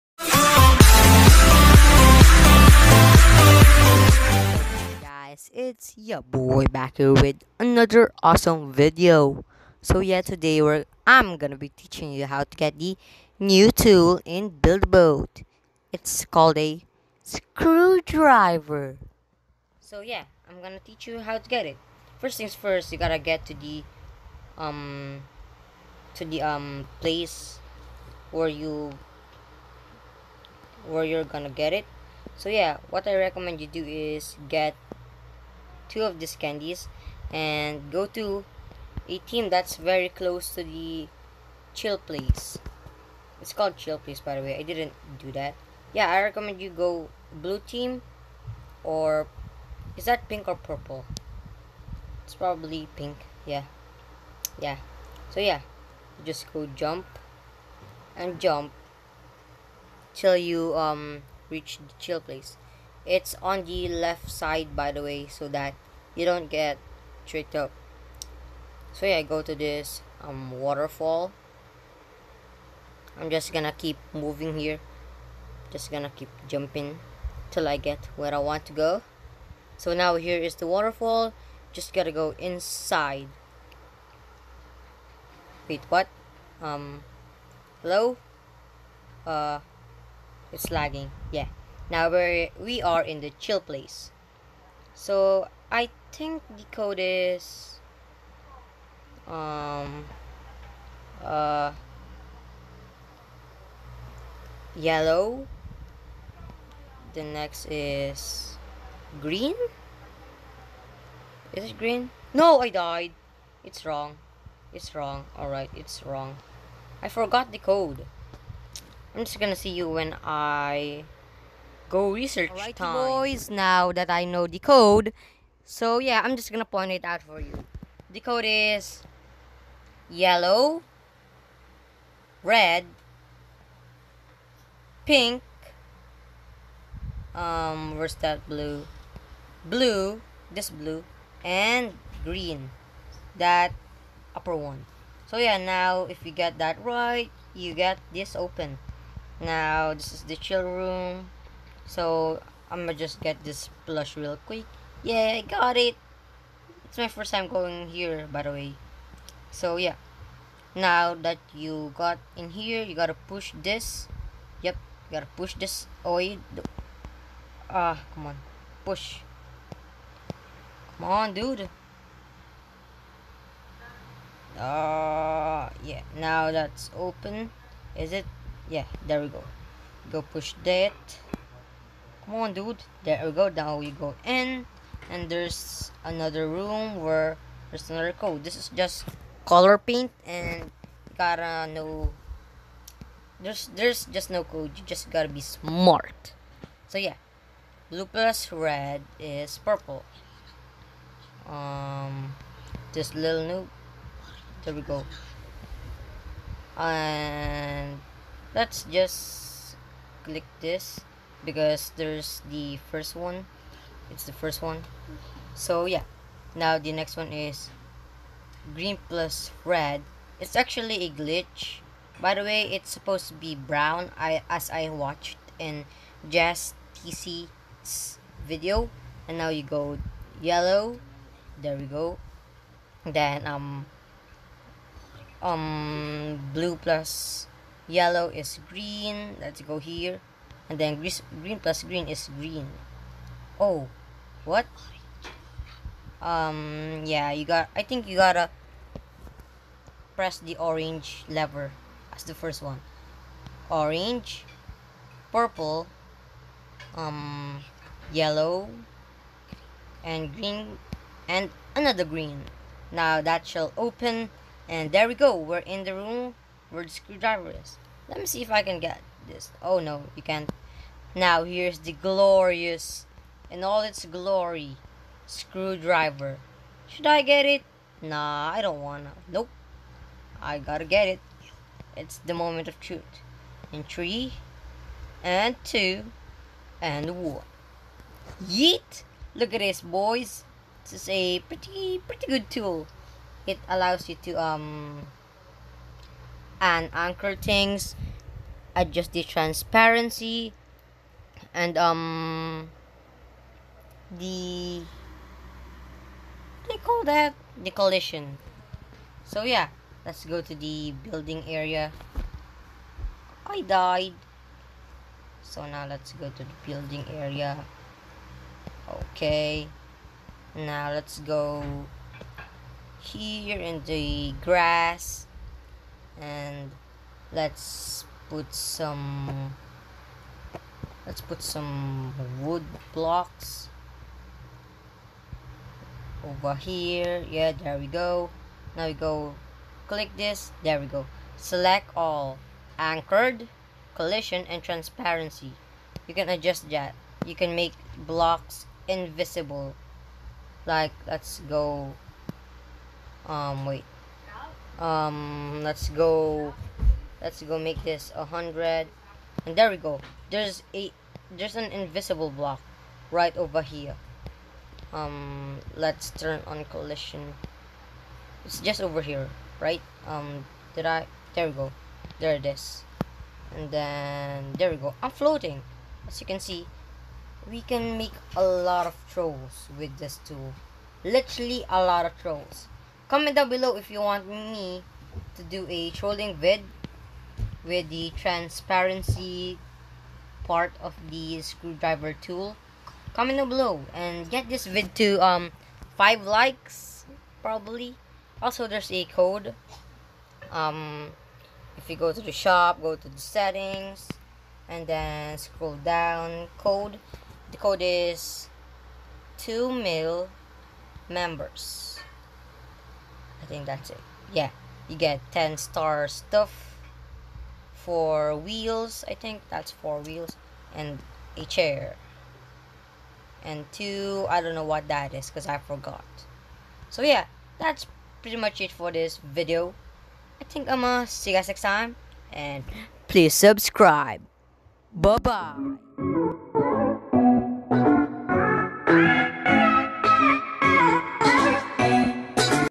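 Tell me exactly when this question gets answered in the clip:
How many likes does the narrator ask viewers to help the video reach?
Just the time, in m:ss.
6:35.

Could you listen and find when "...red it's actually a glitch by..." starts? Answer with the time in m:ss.
3:39.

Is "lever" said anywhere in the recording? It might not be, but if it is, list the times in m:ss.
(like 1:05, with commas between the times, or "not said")
4:11.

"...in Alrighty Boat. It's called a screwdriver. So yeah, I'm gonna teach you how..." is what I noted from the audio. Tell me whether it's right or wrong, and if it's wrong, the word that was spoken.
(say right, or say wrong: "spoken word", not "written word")
wrong: "Build", not "Alrighty".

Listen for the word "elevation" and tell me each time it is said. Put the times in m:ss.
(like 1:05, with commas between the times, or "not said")
not said.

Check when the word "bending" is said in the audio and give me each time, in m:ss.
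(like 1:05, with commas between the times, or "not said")
not said.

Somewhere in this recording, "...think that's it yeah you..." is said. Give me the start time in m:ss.
6:53.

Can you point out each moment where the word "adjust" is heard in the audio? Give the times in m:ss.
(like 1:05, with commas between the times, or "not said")
4:58, 5:46.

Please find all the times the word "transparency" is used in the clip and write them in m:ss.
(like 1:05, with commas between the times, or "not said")
4:59, 5:44, 6:28.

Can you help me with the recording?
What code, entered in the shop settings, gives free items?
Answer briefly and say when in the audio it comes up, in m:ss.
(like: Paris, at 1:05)
2 mil members, at 6:49.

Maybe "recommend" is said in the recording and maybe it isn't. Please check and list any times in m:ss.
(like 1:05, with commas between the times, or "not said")
0:33, 0:46.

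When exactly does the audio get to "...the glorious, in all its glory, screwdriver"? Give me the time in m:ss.
4:31.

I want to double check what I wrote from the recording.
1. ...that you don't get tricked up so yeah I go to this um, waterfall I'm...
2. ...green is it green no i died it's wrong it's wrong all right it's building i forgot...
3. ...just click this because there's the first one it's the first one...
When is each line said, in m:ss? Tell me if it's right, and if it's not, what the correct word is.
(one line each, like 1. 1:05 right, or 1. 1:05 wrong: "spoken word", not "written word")
1. 1:05 right
2. 1:49 wrong: "wrong", not "building"
3. 3:28 right.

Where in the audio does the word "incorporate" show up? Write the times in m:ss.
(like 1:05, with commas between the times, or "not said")
not said.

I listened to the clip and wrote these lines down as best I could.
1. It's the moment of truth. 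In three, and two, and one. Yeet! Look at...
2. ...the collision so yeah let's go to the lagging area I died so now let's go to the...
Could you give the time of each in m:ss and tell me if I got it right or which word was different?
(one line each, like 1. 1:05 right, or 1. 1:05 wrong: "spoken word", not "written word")
1. 4:41 right
2. 5:07 wrong: "building", not "lagging".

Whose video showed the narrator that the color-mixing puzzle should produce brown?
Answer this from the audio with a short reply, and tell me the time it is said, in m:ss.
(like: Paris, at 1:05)
Jazz TC, at 3:46.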